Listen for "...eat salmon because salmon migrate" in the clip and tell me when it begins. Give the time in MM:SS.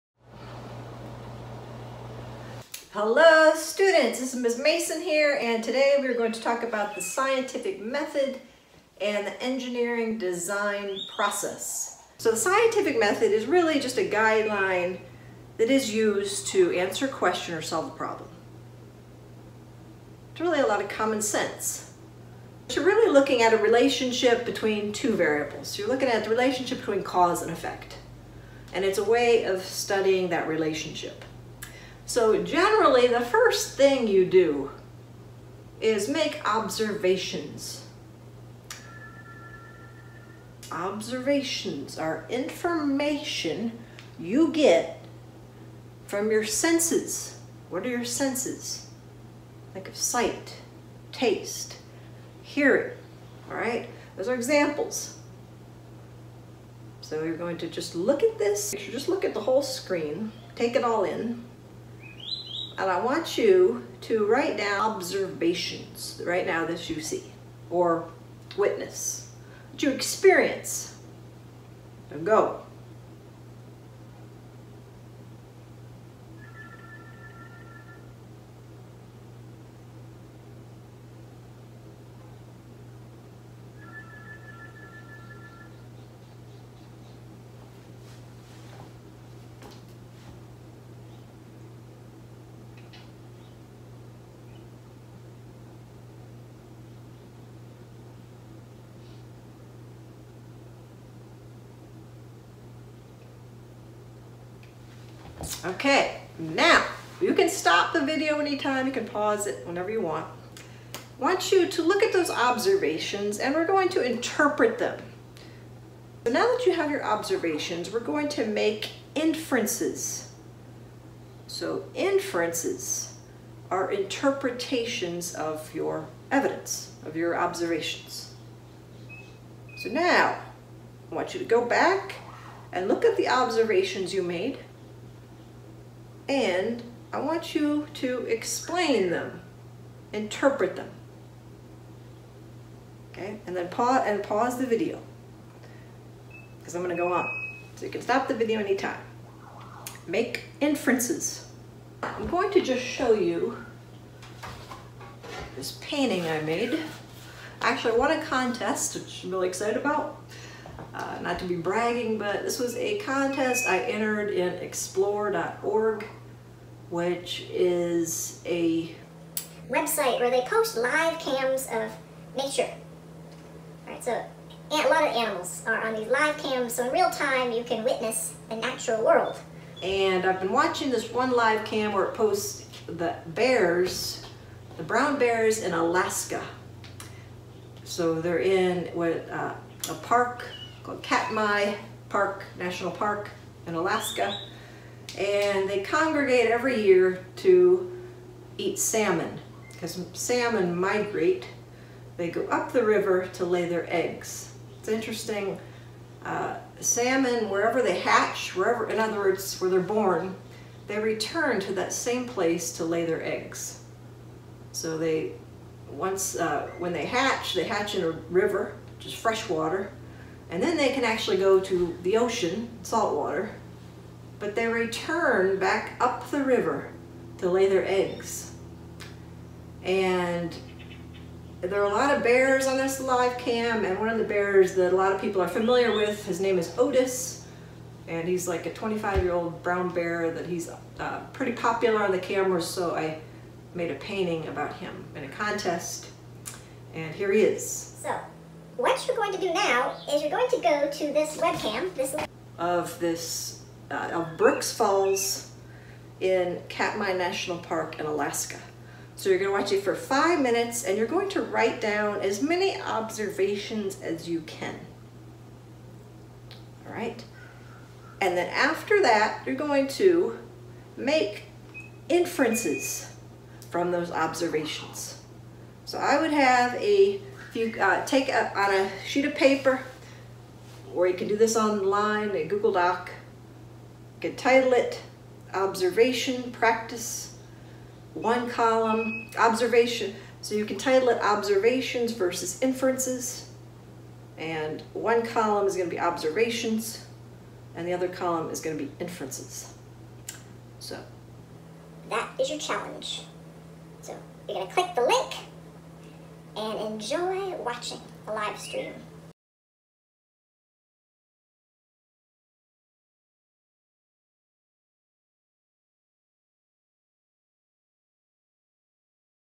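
03:18.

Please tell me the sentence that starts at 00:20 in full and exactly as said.
It's really a lot of common sense.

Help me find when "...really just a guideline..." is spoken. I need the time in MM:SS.
00:13.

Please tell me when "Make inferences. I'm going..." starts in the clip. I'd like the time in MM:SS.
02:30.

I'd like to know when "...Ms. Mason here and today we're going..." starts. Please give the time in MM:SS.
00:04.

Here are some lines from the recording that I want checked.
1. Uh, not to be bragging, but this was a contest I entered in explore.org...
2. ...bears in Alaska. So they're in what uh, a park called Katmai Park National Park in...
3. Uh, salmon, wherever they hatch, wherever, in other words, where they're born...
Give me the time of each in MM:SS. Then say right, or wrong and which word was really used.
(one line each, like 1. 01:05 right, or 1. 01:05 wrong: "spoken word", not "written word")
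1. 02:40 right
2. 03:05 right
3. 03:26 right.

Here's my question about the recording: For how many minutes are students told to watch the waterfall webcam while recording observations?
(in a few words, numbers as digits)
5.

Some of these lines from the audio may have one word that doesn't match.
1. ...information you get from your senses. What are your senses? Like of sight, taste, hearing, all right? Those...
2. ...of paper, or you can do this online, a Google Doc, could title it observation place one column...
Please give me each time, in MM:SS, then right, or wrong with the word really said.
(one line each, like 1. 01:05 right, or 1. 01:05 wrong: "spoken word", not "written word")
1. 00:42 right
2. 04:39 wrong: "practice", not "place".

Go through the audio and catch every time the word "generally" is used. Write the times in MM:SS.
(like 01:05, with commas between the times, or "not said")
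00:32.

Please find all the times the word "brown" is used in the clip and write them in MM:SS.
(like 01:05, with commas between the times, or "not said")
03:04, 03:59.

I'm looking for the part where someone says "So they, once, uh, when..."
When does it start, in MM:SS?
03:34.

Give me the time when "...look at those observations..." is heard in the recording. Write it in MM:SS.
01:51.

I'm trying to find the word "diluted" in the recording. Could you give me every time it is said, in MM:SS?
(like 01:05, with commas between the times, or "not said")
not said.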